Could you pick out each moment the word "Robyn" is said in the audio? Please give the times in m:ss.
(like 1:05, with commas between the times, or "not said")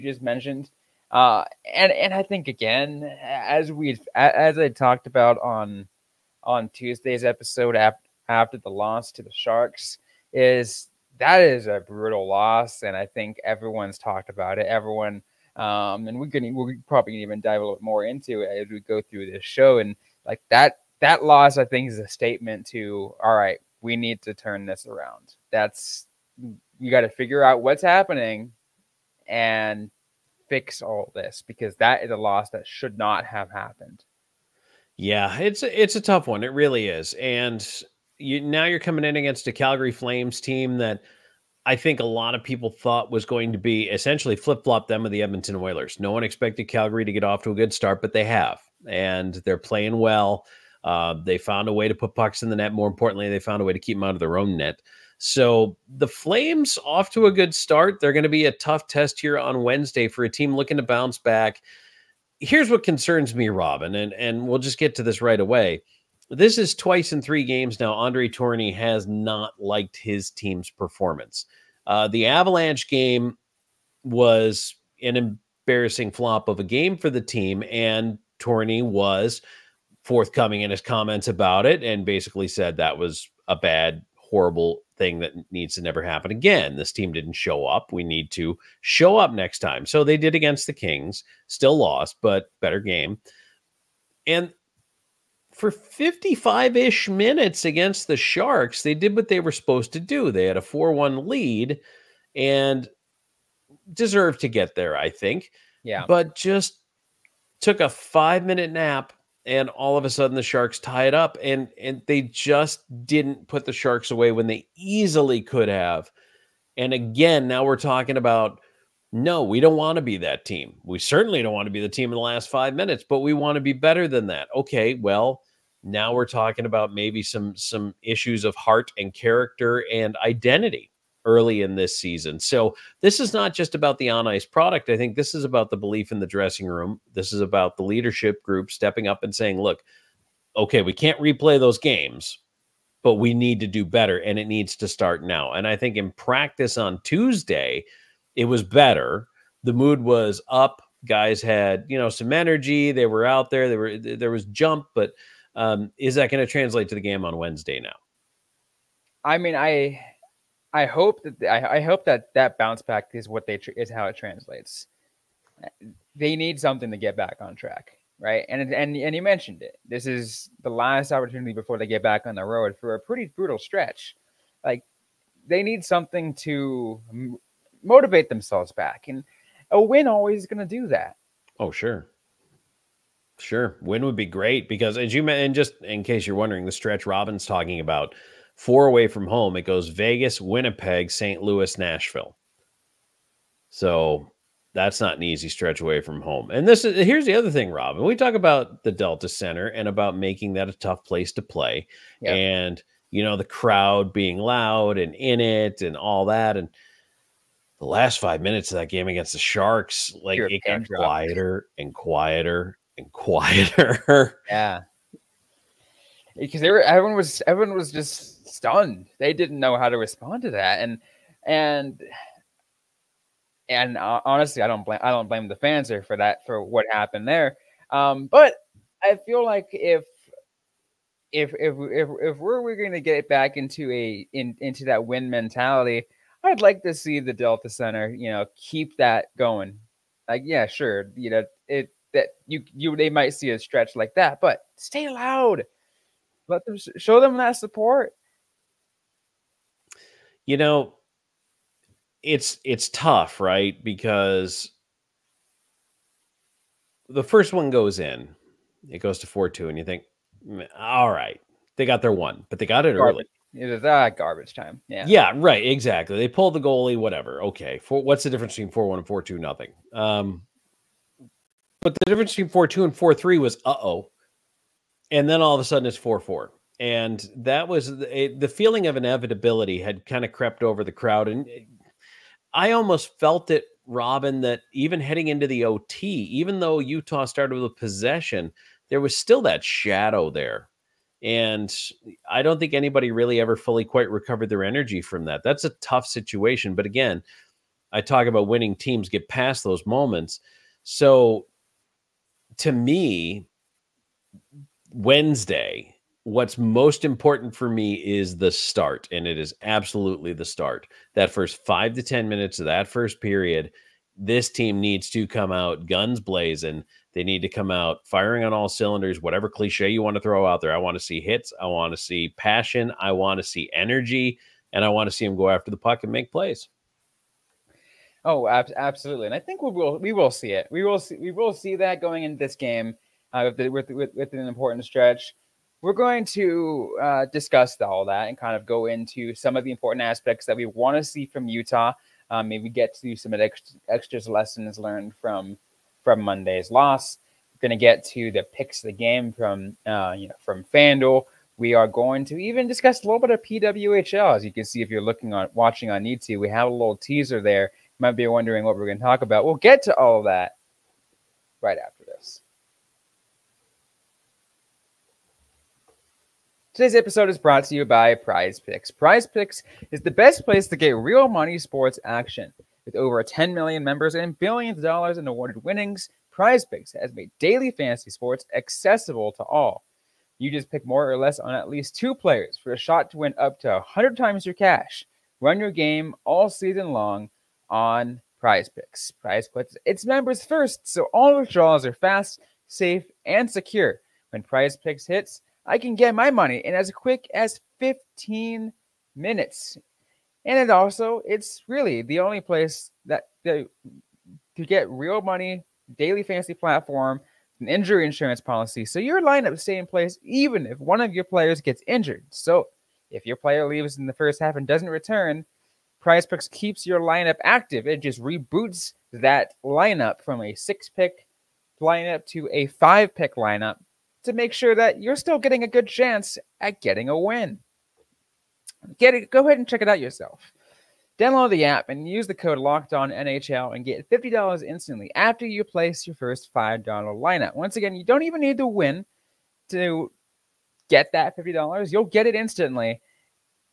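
1:03, 3:07, 3:17, 4:43.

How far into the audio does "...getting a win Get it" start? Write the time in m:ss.
7:06.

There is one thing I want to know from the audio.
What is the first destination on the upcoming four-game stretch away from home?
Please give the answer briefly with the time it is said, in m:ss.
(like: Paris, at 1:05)
Vegas, at 3:09.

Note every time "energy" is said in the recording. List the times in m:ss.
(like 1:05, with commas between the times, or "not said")
2:32, 4:54, 5:23.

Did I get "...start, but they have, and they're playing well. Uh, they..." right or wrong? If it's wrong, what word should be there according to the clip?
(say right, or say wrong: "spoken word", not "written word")
right.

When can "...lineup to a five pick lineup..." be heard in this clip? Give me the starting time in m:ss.
7:01.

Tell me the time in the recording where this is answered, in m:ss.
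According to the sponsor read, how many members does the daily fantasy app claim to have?
6:12.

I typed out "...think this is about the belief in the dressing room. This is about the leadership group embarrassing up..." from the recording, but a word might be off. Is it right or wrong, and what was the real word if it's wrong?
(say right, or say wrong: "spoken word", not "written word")
wrong: "stepping", not "embarrassing".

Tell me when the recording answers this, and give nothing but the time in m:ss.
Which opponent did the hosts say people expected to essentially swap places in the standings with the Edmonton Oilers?
0:39.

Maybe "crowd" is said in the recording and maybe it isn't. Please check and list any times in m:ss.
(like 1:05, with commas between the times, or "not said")
3:23, 4:40.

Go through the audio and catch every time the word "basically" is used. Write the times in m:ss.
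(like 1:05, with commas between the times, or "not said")
1:22.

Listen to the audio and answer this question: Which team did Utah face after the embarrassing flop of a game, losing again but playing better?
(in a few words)
Kings.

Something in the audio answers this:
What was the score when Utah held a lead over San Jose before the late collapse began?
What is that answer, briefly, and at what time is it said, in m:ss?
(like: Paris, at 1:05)
4 1, at 1:40.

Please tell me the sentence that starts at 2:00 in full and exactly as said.
We certainly don't want to be the team in the last five minutes, but we want to be better than that.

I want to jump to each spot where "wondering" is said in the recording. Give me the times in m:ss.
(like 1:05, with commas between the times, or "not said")
3:06, 5:58.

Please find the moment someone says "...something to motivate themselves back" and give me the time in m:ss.
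2:55.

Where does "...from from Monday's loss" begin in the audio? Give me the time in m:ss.
5:45.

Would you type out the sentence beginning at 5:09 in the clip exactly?
And it is absolutely the start.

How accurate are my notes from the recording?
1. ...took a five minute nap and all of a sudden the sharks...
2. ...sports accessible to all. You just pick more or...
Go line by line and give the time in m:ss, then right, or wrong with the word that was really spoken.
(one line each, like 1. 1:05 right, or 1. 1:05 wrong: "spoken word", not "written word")
1. 1:47 right
2. 6:18 right.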